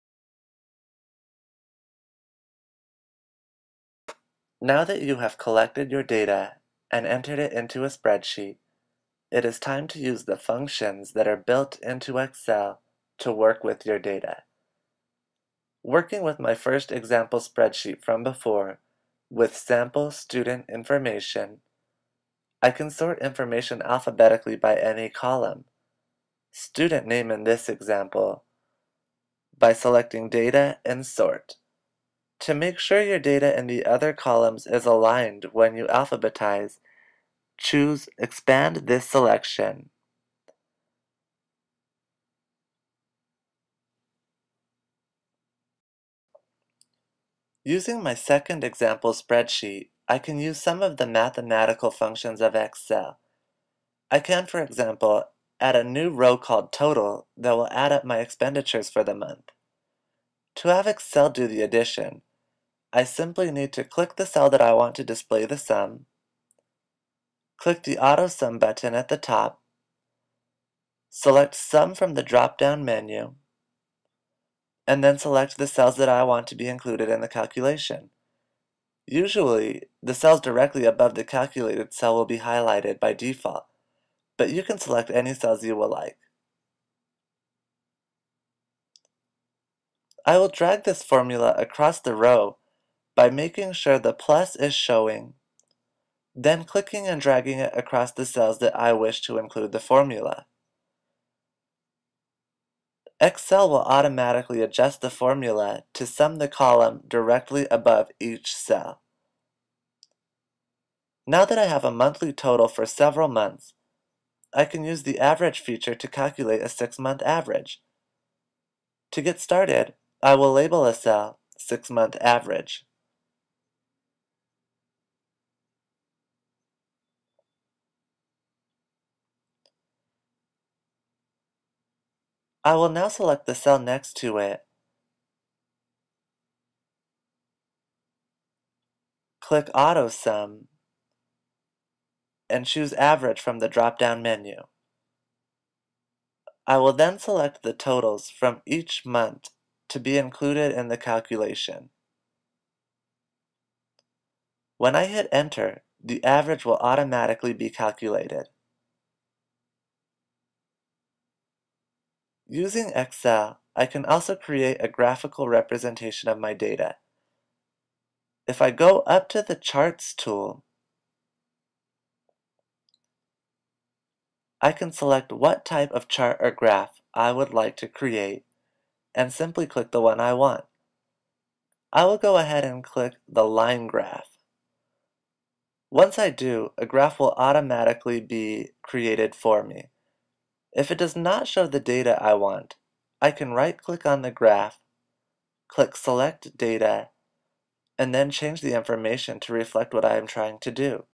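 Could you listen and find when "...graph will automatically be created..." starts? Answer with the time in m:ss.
3:06.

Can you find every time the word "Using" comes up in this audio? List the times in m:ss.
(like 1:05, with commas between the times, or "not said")
0:47, 2:42.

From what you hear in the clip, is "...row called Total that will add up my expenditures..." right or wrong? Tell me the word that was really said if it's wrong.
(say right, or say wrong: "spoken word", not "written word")
right.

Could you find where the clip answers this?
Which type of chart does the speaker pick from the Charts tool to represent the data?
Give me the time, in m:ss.
3:03.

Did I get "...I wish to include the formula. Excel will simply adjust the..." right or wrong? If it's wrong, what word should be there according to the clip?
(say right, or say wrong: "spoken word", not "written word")
wrong: "automatically", not "simply".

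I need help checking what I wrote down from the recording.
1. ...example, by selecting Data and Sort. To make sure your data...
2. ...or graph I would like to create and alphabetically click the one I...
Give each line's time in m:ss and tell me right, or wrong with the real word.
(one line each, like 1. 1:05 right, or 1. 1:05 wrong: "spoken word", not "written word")
1. 0:27 right
2. 2:56 wrong: "simply", not "alphabetically".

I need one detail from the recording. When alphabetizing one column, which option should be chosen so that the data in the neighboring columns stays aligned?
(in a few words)
Expand this selection.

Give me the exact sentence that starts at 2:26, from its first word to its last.
I will then select the totals from each month to be included in the calculation.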